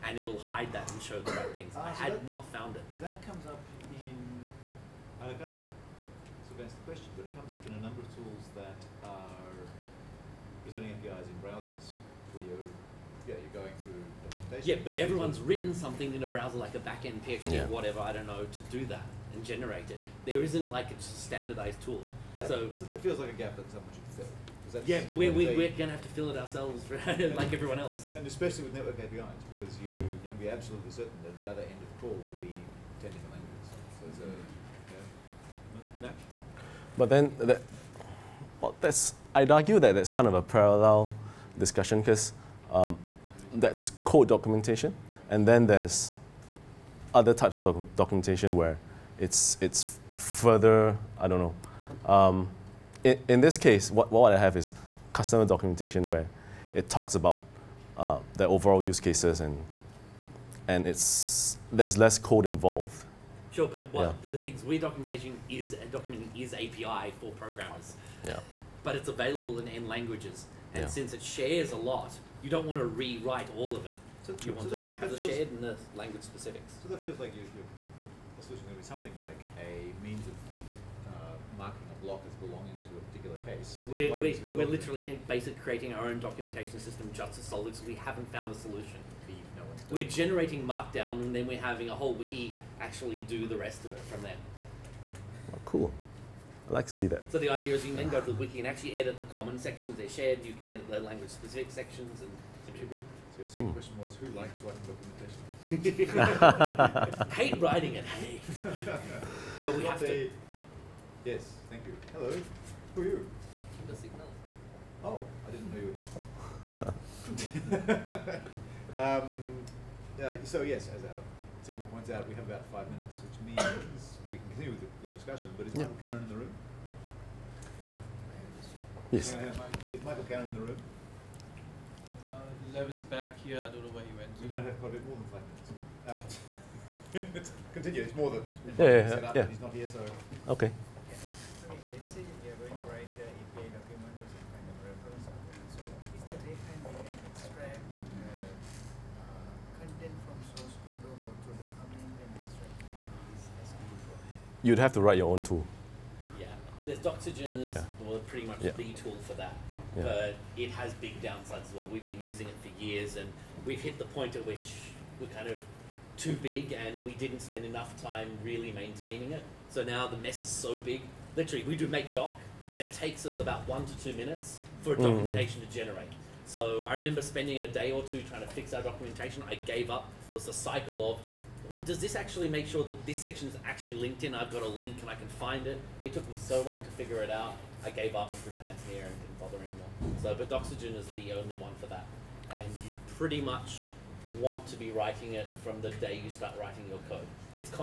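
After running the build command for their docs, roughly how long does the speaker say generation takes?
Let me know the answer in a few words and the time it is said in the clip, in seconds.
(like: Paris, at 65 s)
1 to 2 minutes, at 173 s.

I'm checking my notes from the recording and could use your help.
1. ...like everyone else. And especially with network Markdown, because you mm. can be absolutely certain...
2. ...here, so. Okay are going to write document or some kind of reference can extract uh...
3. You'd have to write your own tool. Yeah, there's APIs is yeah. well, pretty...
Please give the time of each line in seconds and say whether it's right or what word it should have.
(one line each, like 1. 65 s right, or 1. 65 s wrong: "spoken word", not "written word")
1. 27 s wrong: "APIs", not "Markdown"
2. 139 s right
3. 154 s wrong: "Doxygen", not "APIs".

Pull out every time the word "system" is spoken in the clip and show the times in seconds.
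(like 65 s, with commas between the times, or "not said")
86 s.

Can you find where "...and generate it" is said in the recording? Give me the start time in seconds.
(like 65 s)
19 s.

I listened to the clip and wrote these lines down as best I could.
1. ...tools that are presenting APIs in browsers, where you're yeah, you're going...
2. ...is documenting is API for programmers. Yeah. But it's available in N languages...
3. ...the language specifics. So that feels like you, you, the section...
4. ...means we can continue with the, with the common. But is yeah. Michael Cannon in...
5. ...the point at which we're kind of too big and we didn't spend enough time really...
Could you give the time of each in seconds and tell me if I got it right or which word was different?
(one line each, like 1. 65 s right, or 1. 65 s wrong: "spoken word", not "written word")
1. 8 s right
2. 65 s right
3. 75 s wrong: "solution", not "section"
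4. 123 s wrong: "discussion", not "common"
5. 163 s right.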